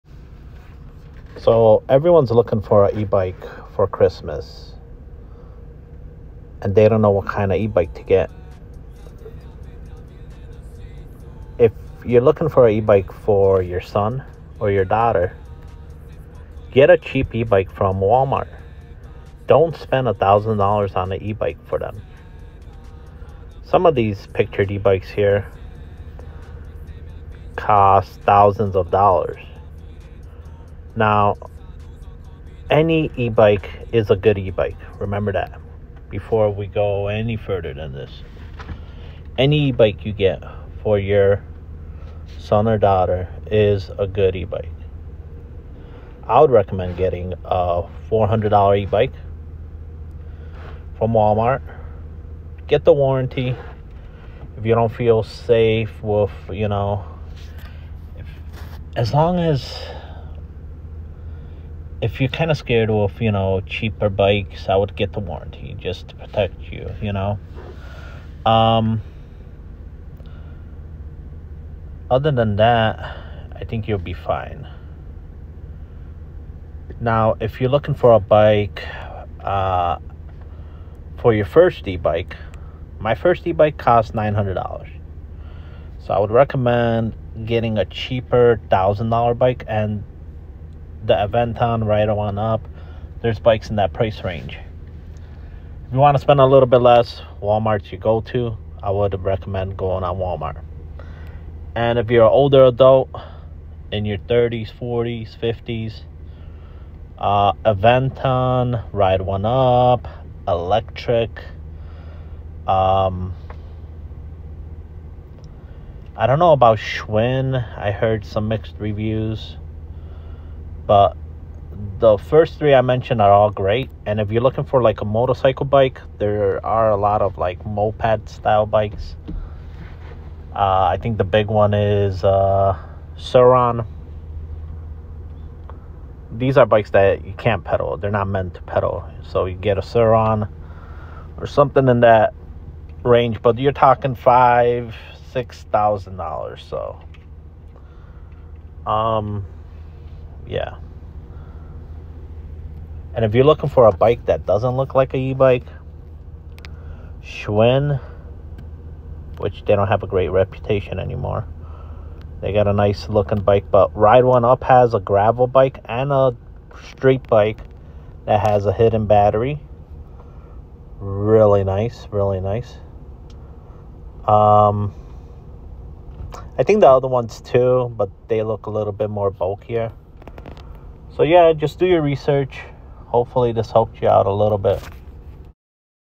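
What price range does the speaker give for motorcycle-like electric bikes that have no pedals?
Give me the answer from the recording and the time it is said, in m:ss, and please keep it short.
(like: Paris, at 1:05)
5,000 to 6,000 dollars, at 2:24.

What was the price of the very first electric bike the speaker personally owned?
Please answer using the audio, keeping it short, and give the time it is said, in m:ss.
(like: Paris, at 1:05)
$900, at 1:24.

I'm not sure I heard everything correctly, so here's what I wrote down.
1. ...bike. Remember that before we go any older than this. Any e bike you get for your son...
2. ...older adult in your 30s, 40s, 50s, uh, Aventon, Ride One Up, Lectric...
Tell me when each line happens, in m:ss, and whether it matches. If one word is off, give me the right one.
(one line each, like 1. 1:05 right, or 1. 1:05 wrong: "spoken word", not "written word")
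1. 0:34 wrong: "further", not "older"
2. 1:42 right.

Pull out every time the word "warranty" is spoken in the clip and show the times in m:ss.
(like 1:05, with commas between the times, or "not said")
0:52, 1:05.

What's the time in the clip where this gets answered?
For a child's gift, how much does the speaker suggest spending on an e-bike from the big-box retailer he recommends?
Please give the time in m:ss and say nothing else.
0:48.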